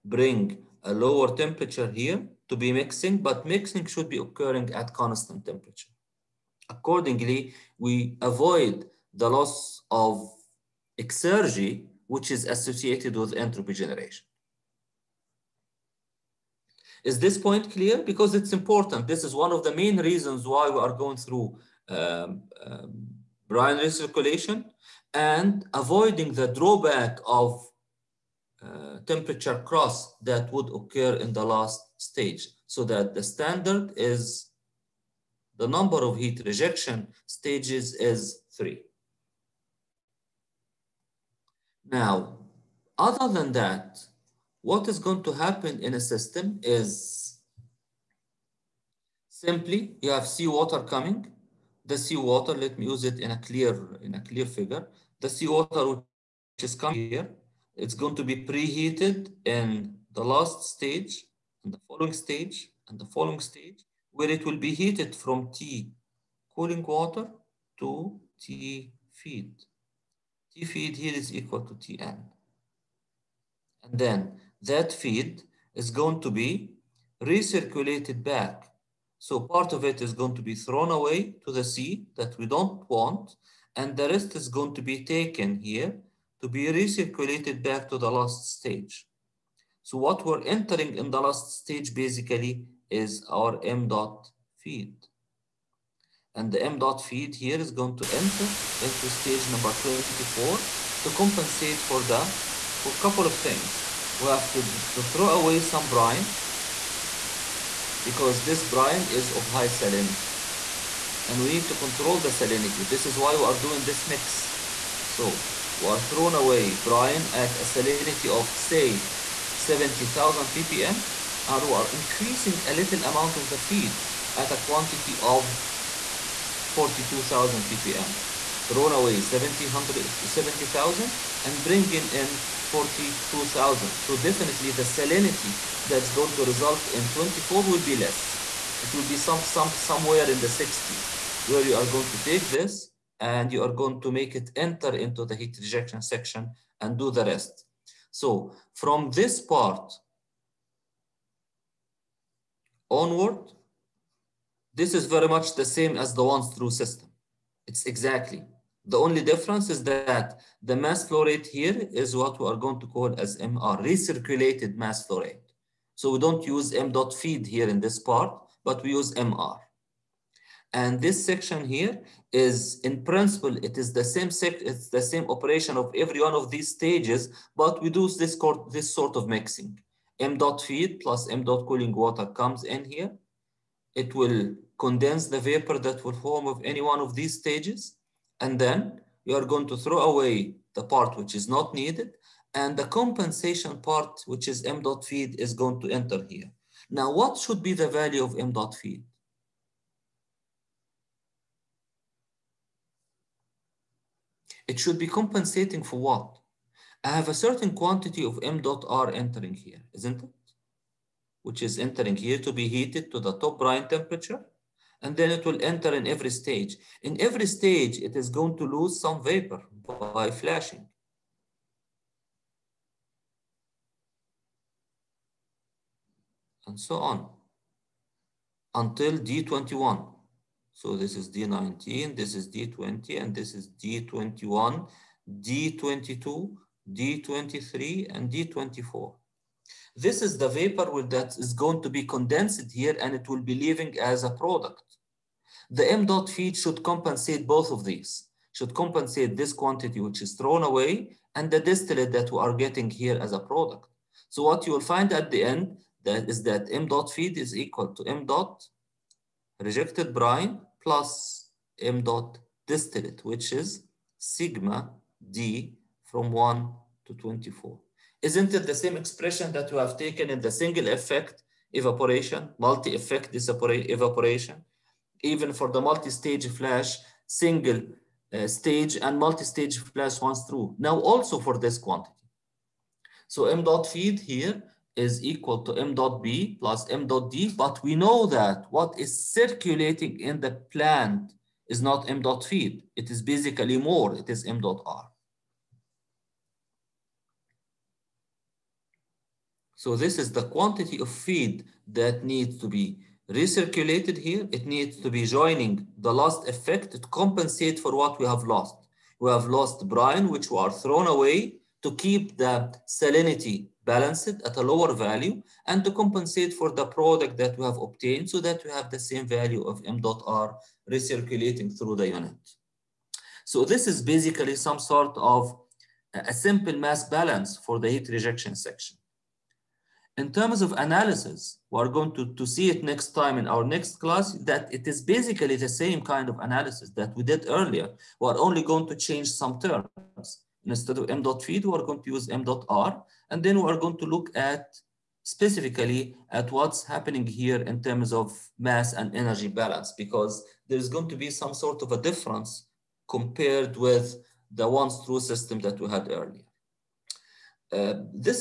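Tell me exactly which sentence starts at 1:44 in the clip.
We have to, to throw away some brine because this brine is of high salinity.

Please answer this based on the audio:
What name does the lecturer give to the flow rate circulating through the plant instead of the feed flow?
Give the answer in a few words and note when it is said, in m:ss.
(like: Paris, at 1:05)
recirculated mass flow rate, at 2:43.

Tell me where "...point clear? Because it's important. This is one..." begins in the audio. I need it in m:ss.
0:17.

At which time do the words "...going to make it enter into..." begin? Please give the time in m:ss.
2:23.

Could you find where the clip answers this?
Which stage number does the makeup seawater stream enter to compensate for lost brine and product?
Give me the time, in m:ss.
1:39.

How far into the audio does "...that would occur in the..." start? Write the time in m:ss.
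0:30.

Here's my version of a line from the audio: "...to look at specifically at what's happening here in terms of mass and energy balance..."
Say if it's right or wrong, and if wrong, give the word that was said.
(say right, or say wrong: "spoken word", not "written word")
right.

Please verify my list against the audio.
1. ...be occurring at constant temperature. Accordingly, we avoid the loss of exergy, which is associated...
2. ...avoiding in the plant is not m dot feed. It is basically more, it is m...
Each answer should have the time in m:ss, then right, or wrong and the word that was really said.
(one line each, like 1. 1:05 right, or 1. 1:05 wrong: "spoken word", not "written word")
1. 0:04 right
2. 4:49 wrong: "circulating", not "avoiding".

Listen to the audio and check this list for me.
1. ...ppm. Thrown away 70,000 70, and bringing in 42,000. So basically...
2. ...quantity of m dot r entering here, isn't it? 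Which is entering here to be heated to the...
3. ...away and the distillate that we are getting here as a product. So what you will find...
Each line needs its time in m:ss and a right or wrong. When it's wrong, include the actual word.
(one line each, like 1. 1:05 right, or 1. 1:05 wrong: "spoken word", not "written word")
1. 2:07 wrong: "definitely", not "basically"
2. 3:27 right
3. 4:10 right.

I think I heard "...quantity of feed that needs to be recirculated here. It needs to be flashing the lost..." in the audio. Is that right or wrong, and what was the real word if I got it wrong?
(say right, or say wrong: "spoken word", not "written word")
wrong: "joining", not "flashing".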